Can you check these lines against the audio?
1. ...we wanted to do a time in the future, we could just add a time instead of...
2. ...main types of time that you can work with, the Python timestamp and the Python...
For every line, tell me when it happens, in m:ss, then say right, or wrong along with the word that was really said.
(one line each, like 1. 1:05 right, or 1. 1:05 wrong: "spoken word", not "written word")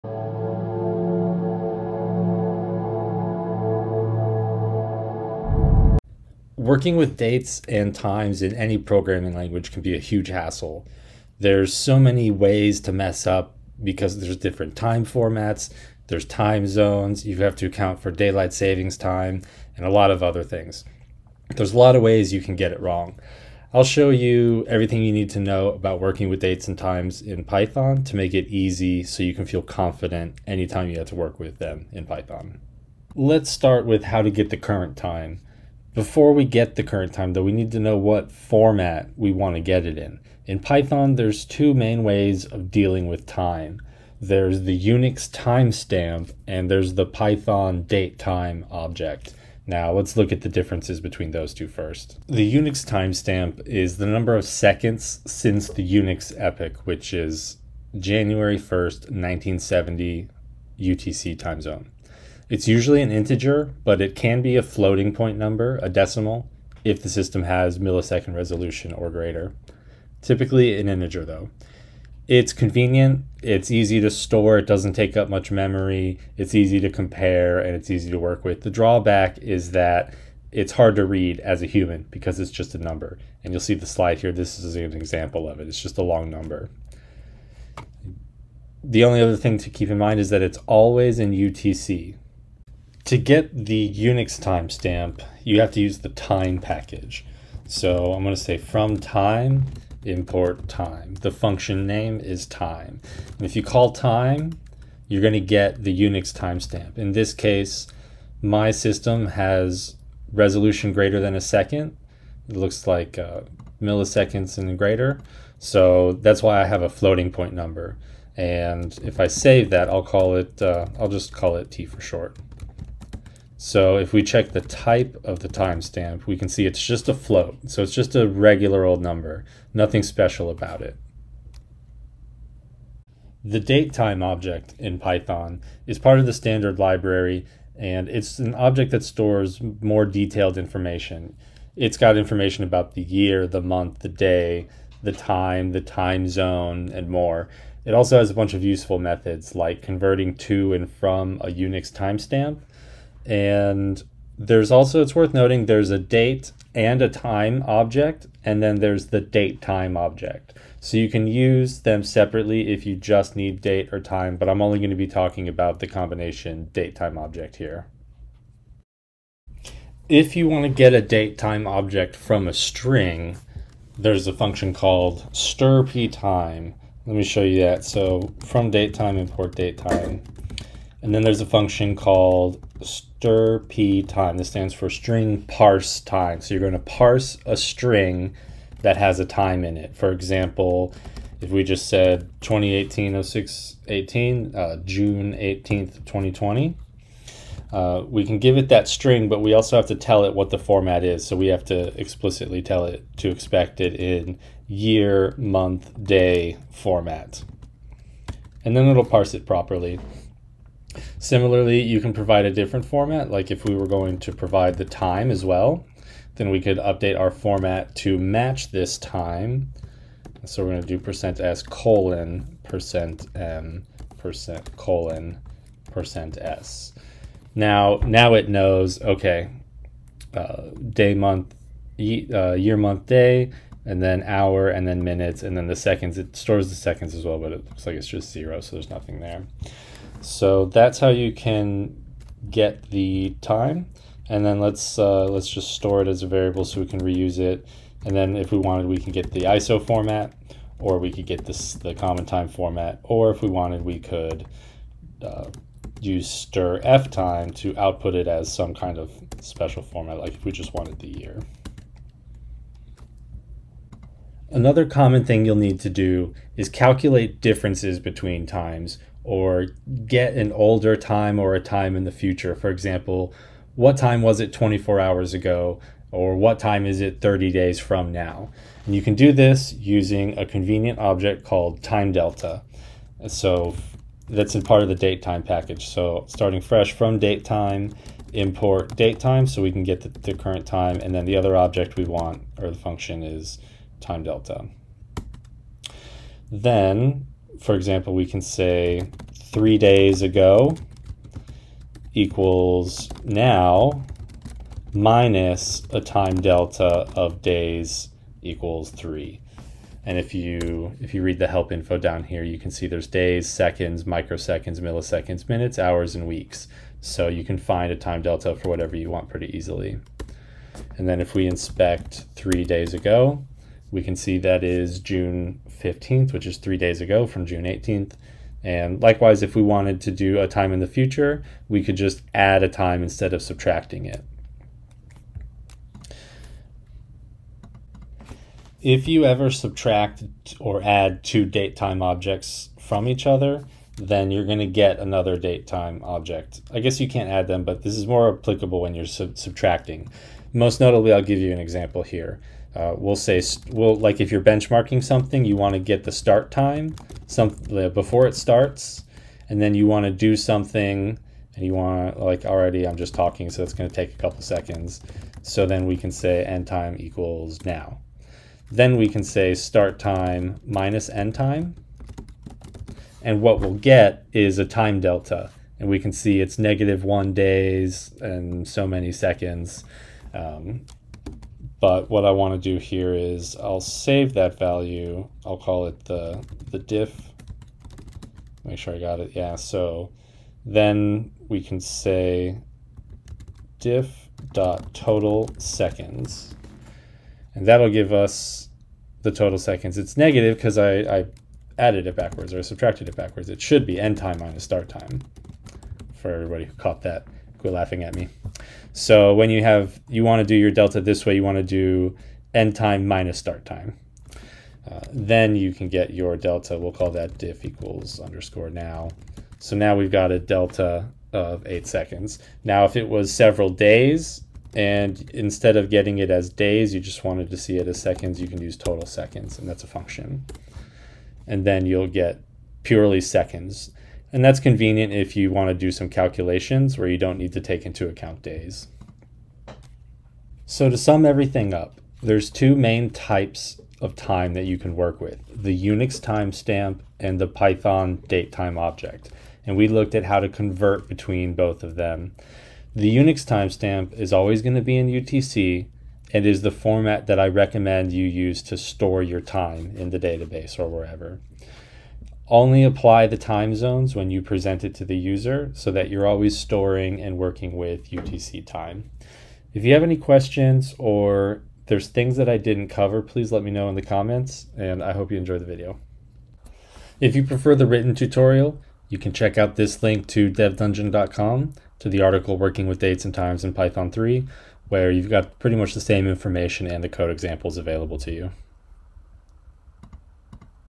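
1. 5:29 right
2. 7:22 wrong: "Unix", not "Python".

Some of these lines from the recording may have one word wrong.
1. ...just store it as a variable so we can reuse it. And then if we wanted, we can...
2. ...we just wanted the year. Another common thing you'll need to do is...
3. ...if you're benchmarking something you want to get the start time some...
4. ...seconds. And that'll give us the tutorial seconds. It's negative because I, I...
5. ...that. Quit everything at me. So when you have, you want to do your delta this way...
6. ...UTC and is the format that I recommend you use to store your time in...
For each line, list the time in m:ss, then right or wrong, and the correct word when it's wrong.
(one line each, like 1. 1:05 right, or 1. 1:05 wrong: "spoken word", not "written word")
1. 4:05 right
2. 4:20 right
3. 5:54 right
4. 6:35 wrong: "total", not "tutorial"
5. 6:47 wrong: "laughing", not "everything"
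6. 7:35 right.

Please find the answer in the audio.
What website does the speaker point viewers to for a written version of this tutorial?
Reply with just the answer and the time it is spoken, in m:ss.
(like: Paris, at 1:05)
devdungeon.com, at 8:00.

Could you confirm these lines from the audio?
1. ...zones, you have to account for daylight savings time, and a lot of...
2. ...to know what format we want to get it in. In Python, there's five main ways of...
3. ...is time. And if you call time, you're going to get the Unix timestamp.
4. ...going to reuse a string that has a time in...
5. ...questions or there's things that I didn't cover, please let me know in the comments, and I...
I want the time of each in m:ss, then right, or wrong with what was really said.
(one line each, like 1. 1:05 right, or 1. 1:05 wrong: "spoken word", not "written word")
1. 0:16 right
2. 0:37 wrong: "two", not "five"
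3. 1:42 right
4. 3:06 wrong: "parse", not "reuse"
5. 7:50 right.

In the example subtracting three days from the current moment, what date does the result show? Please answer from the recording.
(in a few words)
June 15th.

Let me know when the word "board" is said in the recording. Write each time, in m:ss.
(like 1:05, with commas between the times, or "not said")
not said.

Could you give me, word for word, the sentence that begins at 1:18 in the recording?
The drawback is that it's hard to read as a human because it's just a number.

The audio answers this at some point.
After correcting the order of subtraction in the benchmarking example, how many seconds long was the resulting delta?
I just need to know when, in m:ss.
7:01.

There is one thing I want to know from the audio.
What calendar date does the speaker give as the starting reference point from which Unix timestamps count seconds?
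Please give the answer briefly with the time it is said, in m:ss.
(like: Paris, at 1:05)
January 1st, 1970, at 0:57.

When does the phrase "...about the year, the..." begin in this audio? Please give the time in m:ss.
2:22.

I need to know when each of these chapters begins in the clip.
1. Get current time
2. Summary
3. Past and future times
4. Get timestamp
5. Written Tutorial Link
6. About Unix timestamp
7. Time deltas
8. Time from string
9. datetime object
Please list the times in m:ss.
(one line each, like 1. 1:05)
1. 0:32
2. 7:20
3. 4:23
4. 1:32
5. 7:56
6. 0:52
7. 5:37
8. 2:48
9. 2:13.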